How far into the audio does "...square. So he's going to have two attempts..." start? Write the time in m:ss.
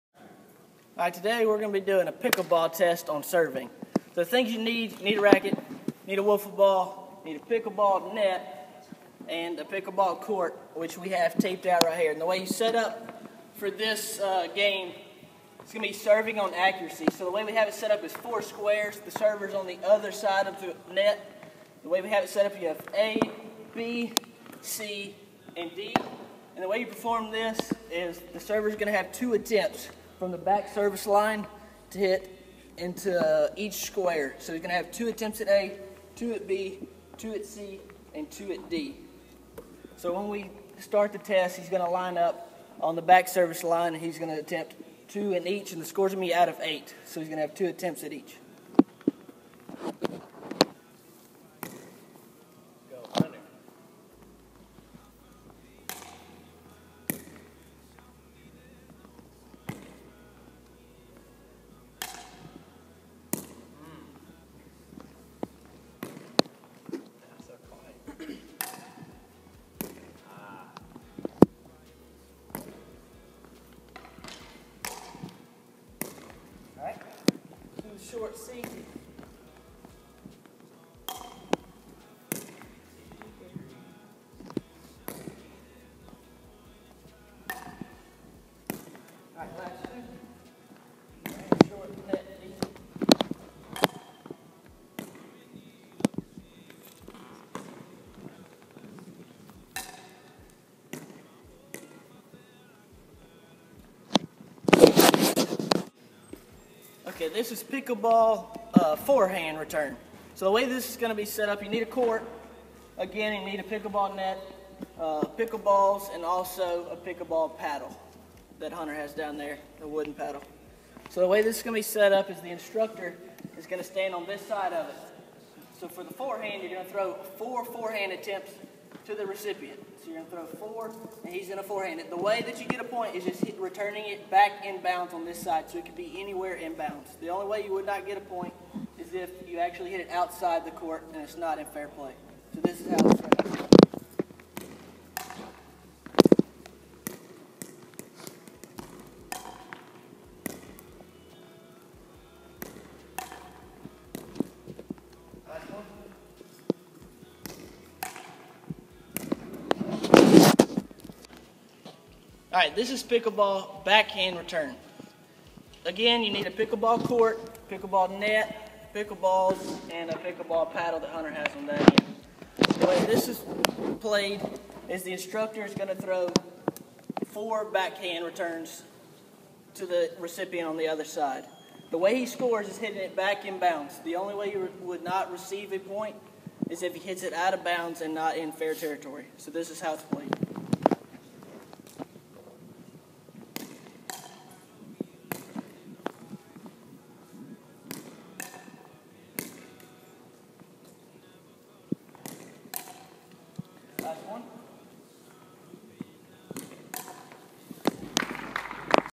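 0:33.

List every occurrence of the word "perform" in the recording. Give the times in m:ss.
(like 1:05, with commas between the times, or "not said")
0:26.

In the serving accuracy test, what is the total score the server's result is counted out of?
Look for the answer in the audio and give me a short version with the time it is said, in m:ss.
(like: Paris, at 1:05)
8, at 0:46.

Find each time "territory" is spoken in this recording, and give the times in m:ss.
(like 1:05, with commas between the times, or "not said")
3:08.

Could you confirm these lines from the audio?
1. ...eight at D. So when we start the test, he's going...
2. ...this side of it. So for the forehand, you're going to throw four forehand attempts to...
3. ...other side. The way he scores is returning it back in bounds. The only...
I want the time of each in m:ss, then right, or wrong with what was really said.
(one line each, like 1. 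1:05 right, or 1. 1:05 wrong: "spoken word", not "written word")
1. 0:38 wrong: "two", not "eight"
2. 2:04 right
3. 3:00 wrong: "hitting", not "returning".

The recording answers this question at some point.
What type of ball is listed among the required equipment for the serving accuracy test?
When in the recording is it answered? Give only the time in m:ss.
0:06.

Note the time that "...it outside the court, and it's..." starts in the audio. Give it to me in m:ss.
2:20.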